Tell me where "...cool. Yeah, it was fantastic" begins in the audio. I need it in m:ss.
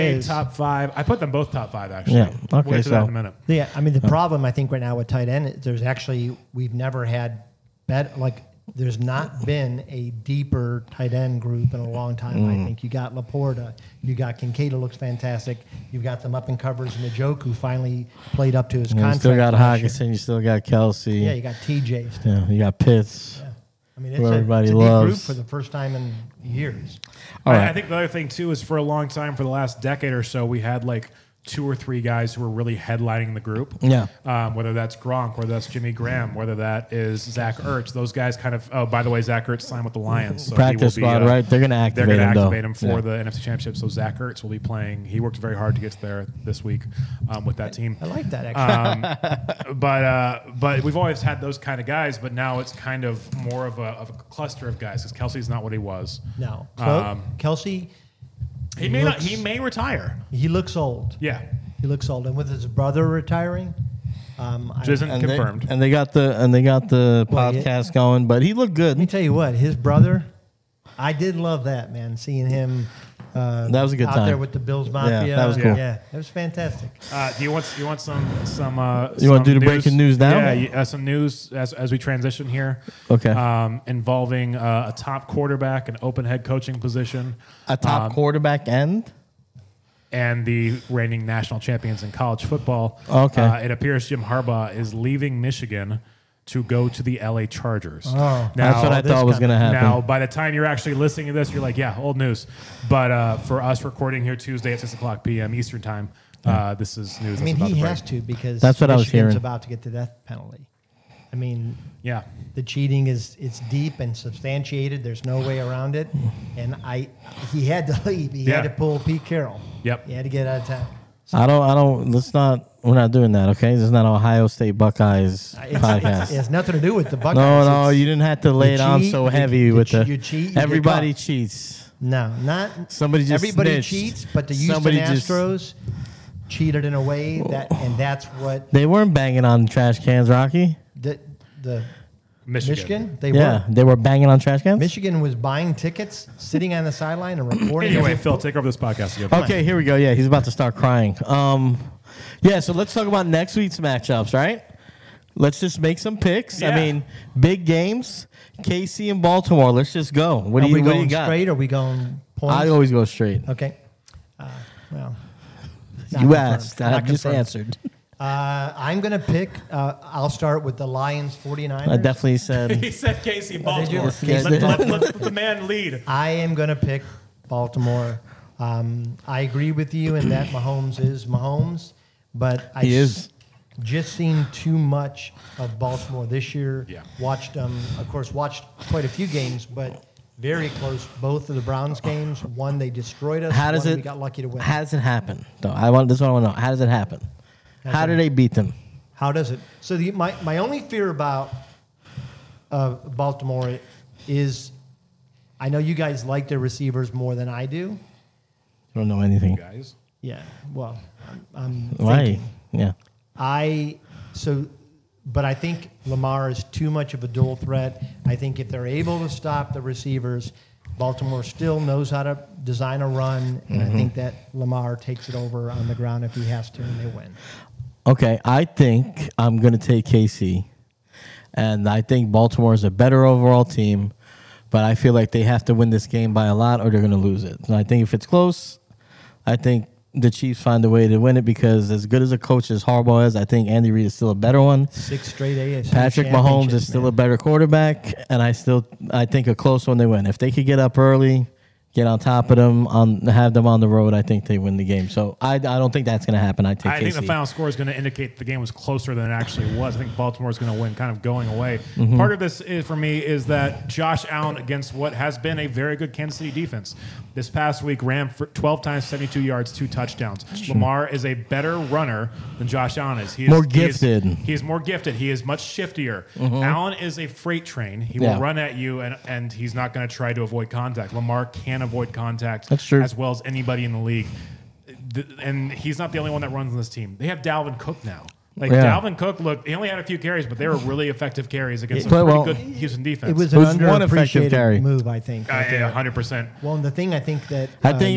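1:15.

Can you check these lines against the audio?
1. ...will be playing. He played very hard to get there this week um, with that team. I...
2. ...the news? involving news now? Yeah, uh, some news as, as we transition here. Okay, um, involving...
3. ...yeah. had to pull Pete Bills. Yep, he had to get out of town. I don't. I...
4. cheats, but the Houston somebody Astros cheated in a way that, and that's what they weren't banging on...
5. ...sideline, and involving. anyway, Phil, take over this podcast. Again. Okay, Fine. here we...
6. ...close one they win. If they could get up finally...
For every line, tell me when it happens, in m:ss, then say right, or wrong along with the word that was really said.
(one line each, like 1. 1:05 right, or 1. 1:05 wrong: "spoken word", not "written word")
1. 0:44 wrong: "worked", not "played"
2. 1:19 wrong: "breaking", not "involving"
3. 1:58 wrong: "Carroll", not "Bills"
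4. 2:13 right
5. 2:26 wrong: "reporting", not "involving"
6. 4:09 wrong: "early", not "finally".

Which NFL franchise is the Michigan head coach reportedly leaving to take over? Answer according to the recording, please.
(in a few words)
LA Chargers.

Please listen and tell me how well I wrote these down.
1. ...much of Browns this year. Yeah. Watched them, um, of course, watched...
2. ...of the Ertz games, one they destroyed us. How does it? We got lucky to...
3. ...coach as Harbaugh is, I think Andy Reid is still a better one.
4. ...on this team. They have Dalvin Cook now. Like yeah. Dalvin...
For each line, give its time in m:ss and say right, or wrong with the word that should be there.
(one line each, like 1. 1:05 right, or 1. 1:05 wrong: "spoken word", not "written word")
1. 3:04 wrong: "Baltimore", not "Browns"
2. 3:11 wrong: "Browns", not "Ertz"
3. 4:02 right
4. 4:46 right.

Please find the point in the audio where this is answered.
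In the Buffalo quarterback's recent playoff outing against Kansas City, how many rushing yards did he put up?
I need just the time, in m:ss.
4:29.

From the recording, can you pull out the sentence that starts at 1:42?
But uh, for us recording here Tuesday at 6 o'clock p.m.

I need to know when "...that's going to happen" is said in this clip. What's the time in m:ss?
4:16.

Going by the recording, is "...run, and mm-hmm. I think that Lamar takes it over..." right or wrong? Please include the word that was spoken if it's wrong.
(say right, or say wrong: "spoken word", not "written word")
right.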